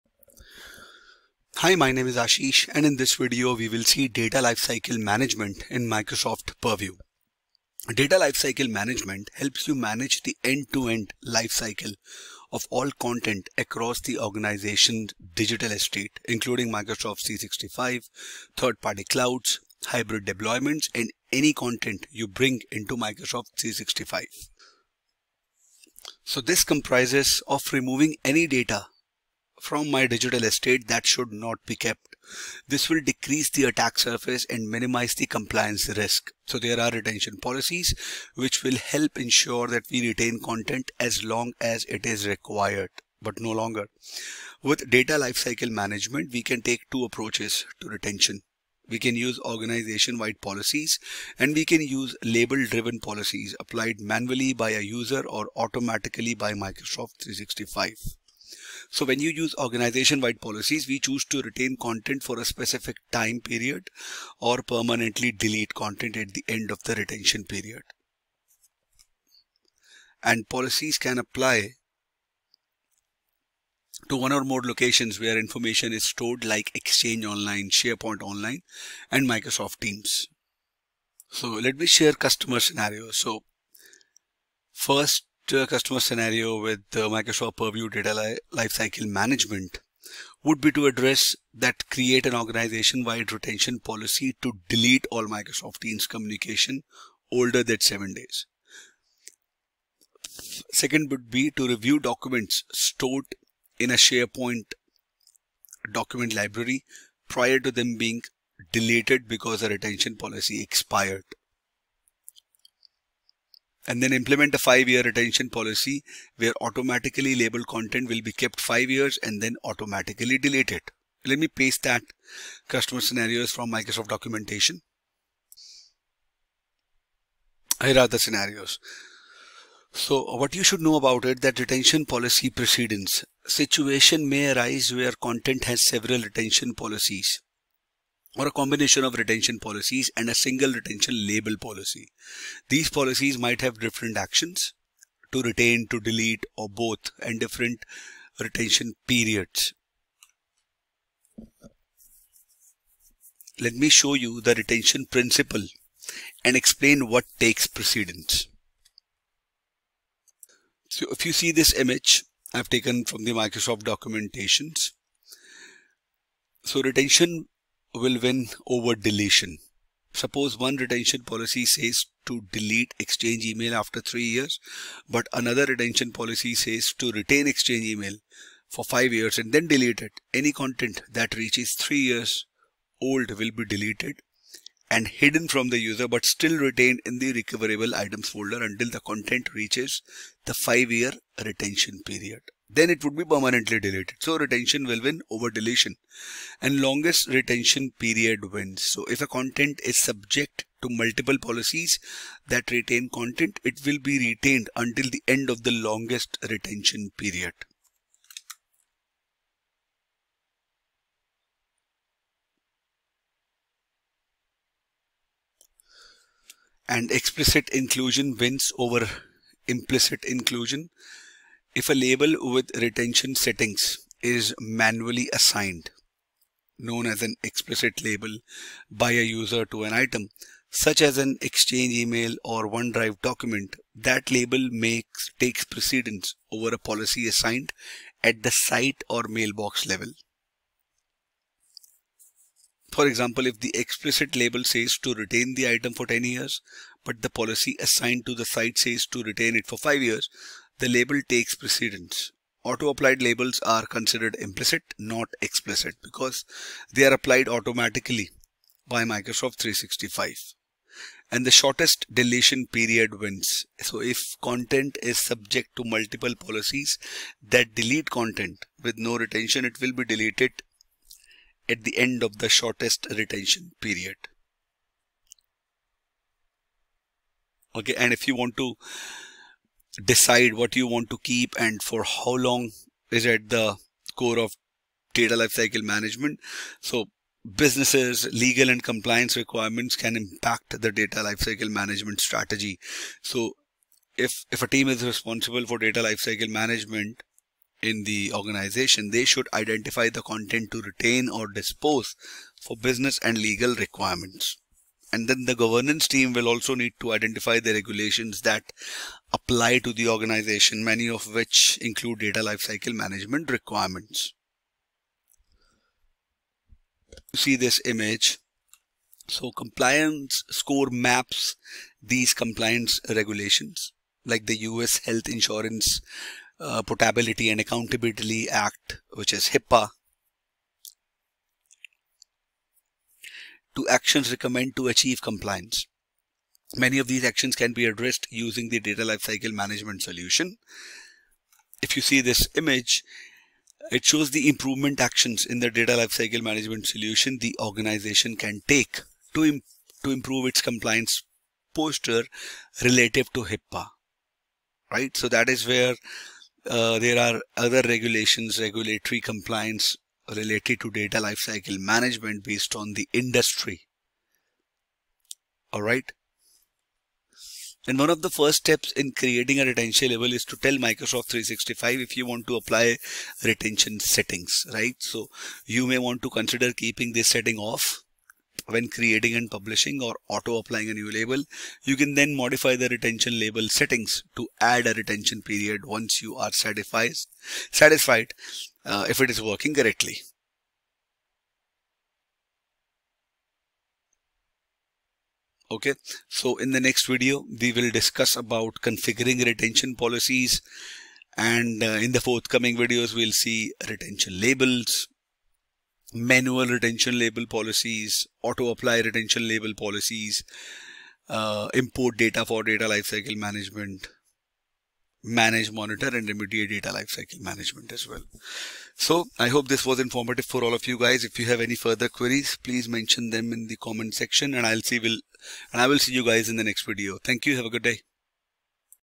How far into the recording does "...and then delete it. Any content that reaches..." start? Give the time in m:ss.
2:59.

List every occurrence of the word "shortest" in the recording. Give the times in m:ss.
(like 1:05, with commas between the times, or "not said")
4:21, 4:32.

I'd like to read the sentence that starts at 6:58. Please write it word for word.
So I hope this was informative for all of you guys.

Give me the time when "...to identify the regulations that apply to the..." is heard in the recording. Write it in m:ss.
5:07.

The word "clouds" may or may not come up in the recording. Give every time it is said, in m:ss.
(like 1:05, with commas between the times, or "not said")
0:19.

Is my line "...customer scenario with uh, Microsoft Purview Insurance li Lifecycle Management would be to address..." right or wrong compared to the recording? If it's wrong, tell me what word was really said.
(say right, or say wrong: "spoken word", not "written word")
wrong: "Data", not "Insurance".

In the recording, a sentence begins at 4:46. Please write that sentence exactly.
So businesses, legal and compliance requirements can impact the data lifecycle management strategy.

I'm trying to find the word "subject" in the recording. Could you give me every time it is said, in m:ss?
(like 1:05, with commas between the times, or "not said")
3:20, 4:25.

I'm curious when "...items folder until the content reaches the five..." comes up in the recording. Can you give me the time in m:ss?
3:07.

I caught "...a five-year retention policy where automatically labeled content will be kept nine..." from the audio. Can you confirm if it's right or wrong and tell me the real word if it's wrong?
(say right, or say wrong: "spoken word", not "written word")
wrong: "five", not "nine".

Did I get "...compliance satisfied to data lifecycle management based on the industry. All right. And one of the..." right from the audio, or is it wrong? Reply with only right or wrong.
wrong.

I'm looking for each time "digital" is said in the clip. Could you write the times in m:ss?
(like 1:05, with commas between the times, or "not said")
0:15, 0:30.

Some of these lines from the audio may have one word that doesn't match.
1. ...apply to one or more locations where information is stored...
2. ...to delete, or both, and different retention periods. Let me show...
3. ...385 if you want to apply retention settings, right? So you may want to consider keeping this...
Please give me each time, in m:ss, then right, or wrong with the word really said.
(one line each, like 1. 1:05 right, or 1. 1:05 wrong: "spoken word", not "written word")
1. 1:11 right
2. 2:25 right
3. 6:11 wrong: "365", not "385".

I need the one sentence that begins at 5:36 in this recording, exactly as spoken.
Many of these actions can be addressed using the data lifecycle management solution.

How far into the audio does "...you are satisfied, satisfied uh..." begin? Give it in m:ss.
6:26.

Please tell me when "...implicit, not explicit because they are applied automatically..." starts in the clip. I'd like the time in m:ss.
4:14.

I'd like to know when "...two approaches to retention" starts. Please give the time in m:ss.
0:46.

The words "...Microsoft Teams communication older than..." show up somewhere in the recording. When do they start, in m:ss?
1:35.